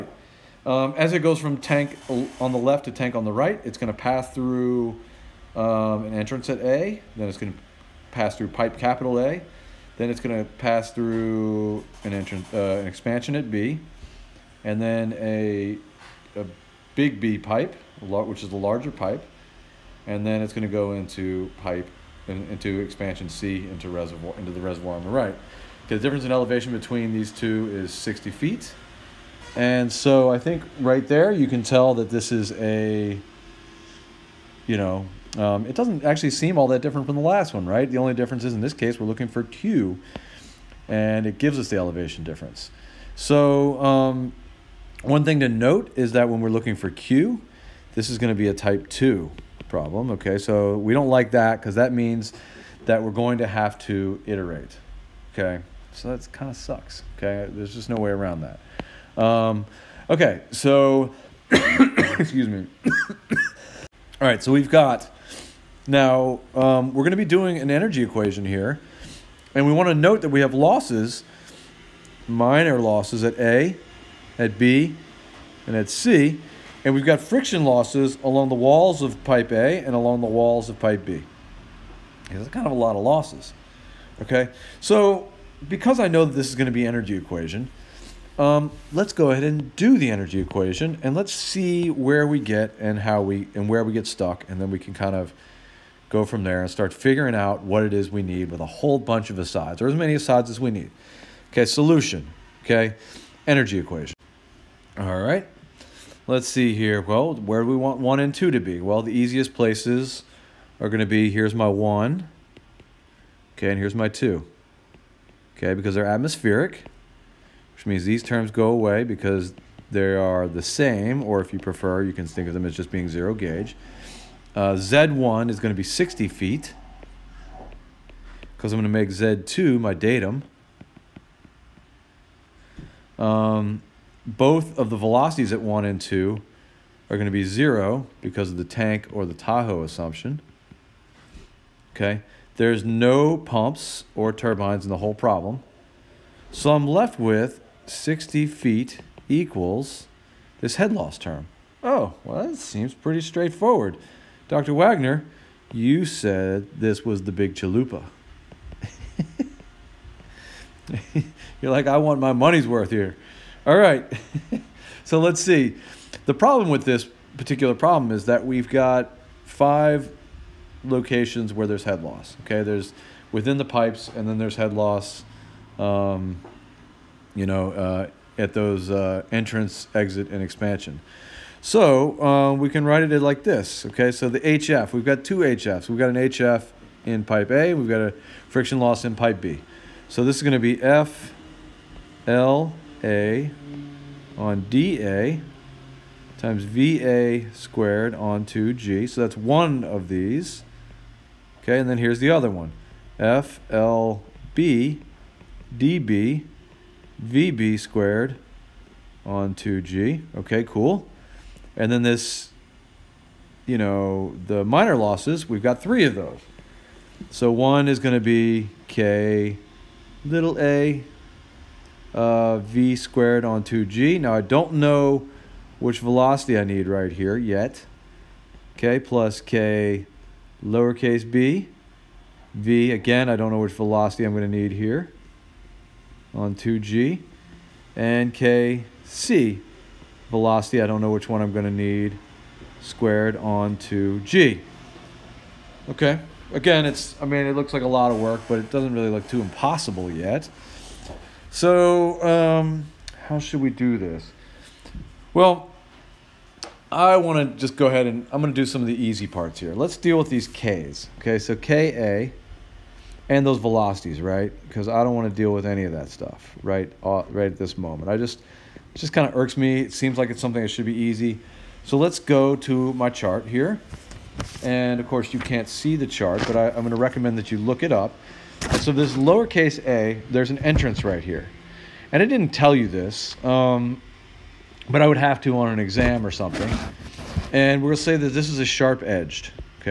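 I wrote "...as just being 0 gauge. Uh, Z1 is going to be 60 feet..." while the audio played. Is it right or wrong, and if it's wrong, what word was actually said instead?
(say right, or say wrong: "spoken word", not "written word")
right.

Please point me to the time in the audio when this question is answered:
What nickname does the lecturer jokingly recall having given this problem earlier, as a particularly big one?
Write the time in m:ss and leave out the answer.
2:37.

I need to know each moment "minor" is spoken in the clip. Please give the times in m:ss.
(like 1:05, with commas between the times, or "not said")
1:12, 3:34.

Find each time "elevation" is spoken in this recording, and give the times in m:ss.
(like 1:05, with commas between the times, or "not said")
0:26, 0:41.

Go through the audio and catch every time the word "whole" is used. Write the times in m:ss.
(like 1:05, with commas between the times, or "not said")
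1:38, 2:24.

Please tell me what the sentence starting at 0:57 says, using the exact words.
Okay, there's just no way around that.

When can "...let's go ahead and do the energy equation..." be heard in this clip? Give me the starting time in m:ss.
1:28.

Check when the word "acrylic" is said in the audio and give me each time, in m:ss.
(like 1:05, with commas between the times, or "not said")
not said.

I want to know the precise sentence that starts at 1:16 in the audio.
And we've got friction losses along the walls of pipe A and along the walls of pipe B.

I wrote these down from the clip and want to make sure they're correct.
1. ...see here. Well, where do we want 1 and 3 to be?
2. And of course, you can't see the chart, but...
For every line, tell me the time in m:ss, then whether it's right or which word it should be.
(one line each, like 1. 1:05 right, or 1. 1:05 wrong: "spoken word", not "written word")
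1. 1:46 wrong: "2", not "3"
2. 4:34 right.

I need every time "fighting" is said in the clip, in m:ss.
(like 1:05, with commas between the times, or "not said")
not said.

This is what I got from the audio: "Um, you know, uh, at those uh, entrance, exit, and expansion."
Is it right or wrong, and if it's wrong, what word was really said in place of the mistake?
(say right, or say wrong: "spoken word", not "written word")
right.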